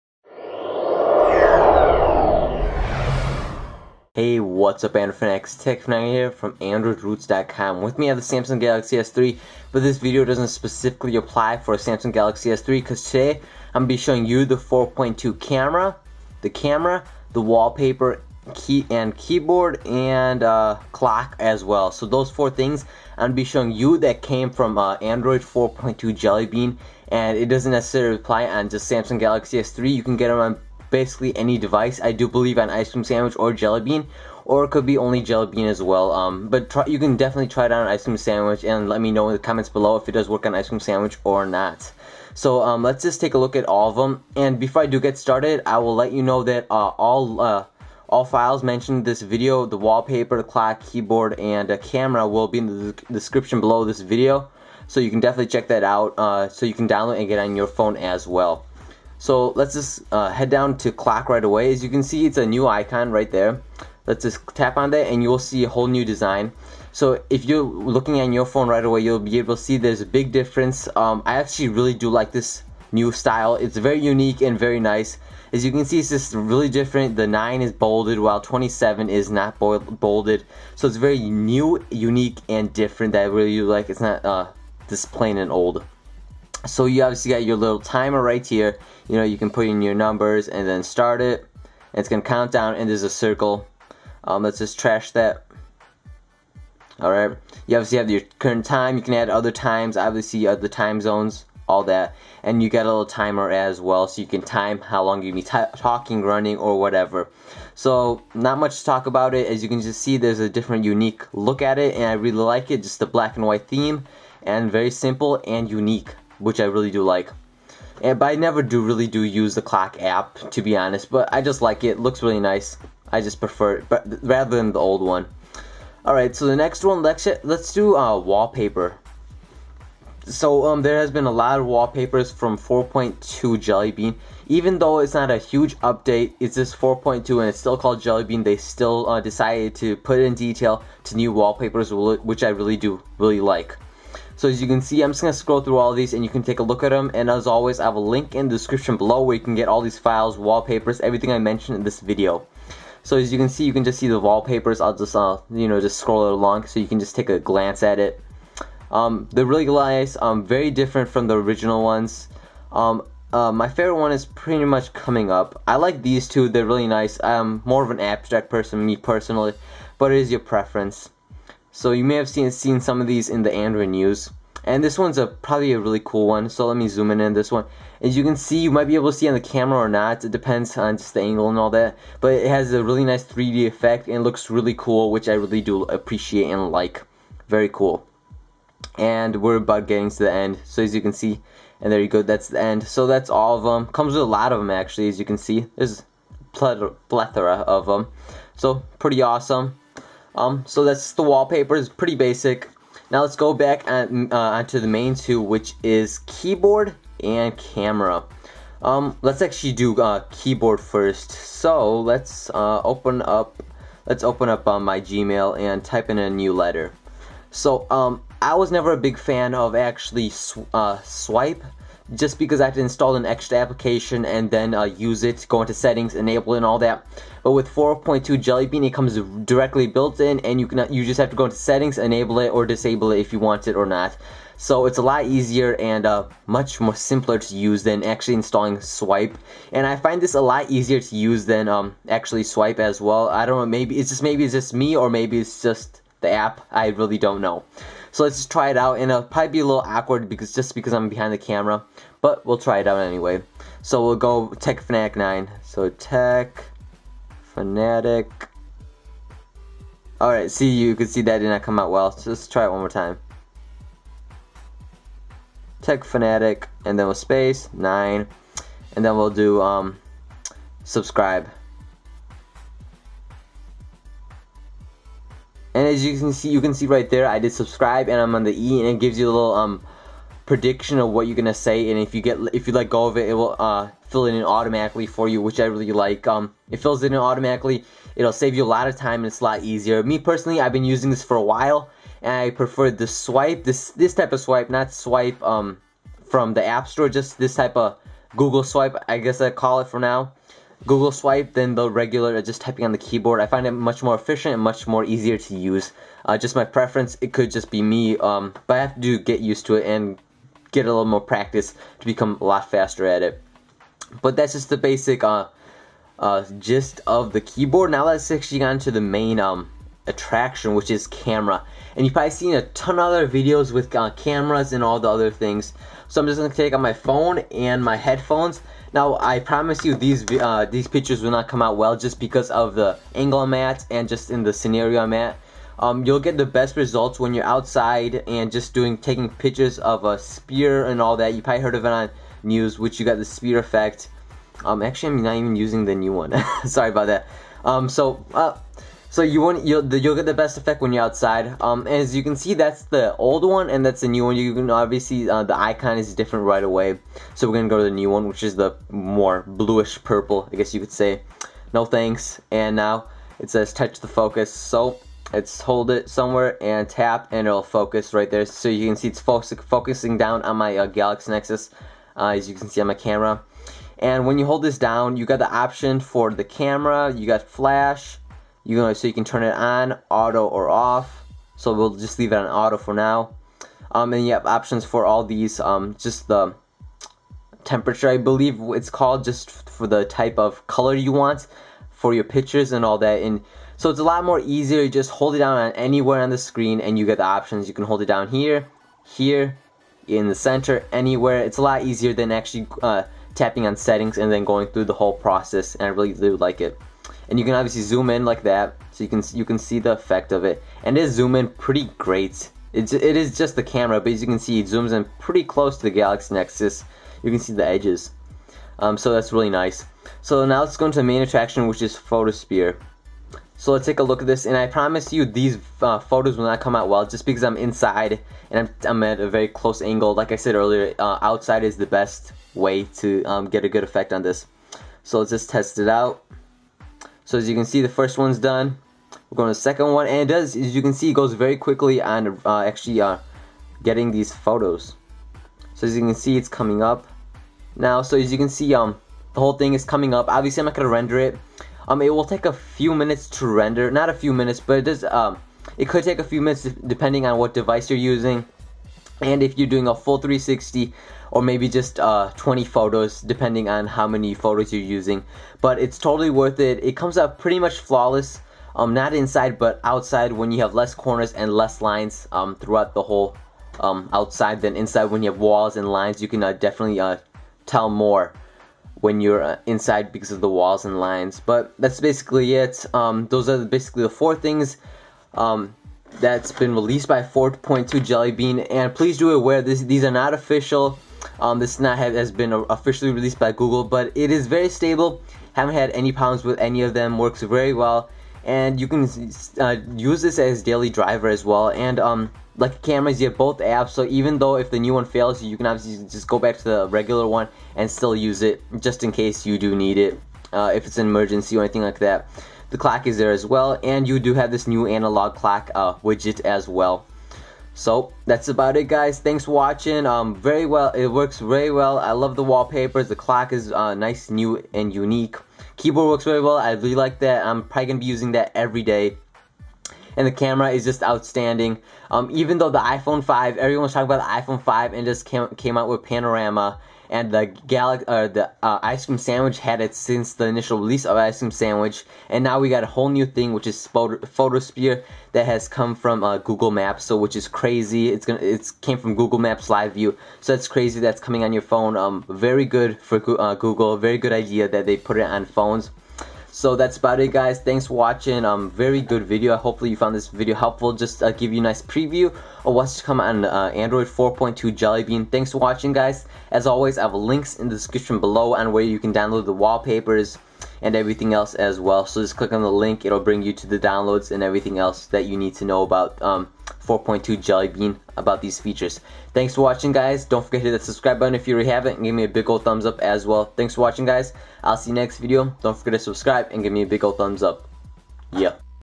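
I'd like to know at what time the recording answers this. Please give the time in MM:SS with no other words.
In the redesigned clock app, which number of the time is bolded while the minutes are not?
01:17.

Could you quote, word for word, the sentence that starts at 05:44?
Um, actually, I'm not even using the new one.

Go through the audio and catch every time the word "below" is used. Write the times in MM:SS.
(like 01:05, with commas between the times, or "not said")
00:39, 00:53, 02:28, 09:28.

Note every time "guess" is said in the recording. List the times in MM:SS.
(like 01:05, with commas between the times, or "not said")
04:59, 06:00.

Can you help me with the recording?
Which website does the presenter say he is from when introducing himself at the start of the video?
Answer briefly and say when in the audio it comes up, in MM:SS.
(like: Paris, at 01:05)
AndroidRootz.com, at 00:06.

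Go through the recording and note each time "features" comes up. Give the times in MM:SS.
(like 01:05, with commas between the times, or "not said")
09:38.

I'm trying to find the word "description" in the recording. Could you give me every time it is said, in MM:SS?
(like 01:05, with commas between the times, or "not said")
00:53, 02:28, 09:27.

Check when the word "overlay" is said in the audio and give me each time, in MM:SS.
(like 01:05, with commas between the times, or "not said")
not said.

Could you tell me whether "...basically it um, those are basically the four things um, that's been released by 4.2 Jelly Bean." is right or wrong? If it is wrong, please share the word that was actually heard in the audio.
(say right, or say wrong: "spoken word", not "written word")
right.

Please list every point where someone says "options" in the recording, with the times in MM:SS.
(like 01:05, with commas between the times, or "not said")
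06:15, 06:24, 06:37.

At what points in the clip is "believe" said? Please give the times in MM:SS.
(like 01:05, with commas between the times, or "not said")
00:32, 06:28.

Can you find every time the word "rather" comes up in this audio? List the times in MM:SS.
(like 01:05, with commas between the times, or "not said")
02:04.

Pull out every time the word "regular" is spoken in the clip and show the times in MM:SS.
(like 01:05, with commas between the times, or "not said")
05:01, 08:26.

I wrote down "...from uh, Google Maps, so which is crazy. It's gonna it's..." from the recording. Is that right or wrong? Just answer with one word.
right.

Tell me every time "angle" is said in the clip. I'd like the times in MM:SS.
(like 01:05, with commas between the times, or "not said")
03:01, 05:33, 07:09.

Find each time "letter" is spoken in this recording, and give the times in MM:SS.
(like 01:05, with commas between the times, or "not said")
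03:36.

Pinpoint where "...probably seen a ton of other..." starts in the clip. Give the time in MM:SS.
05:22.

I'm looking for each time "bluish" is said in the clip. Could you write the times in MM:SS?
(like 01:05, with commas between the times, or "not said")
05:59.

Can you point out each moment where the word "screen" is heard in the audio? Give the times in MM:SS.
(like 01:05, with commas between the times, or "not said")
06:36.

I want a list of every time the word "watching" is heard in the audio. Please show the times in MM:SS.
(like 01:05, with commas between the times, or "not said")
08:39, 09:17, 09:25, 09:39, 09:43.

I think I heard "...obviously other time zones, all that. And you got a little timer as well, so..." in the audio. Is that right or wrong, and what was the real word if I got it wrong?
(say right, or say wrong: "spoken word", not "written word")
right.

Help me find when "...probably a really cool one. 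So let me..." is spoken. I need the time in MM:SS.
02:55.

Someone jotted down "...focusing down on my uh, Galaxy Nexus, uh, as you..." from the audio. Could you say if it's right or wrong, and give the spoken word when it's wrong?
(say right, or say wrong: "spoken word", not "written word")
right.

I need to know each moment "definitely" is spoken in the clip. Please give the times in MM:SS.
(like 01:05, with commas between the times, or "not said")
00:37, 00:55, 07:56.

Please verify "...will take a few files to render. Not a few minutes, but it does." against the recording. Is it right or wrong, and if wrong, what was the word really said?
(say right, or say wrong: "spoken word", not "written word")
wrong: "minutes", not "files".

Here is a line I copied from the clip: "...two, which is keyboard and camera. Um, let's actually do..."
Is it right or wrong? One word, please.
right.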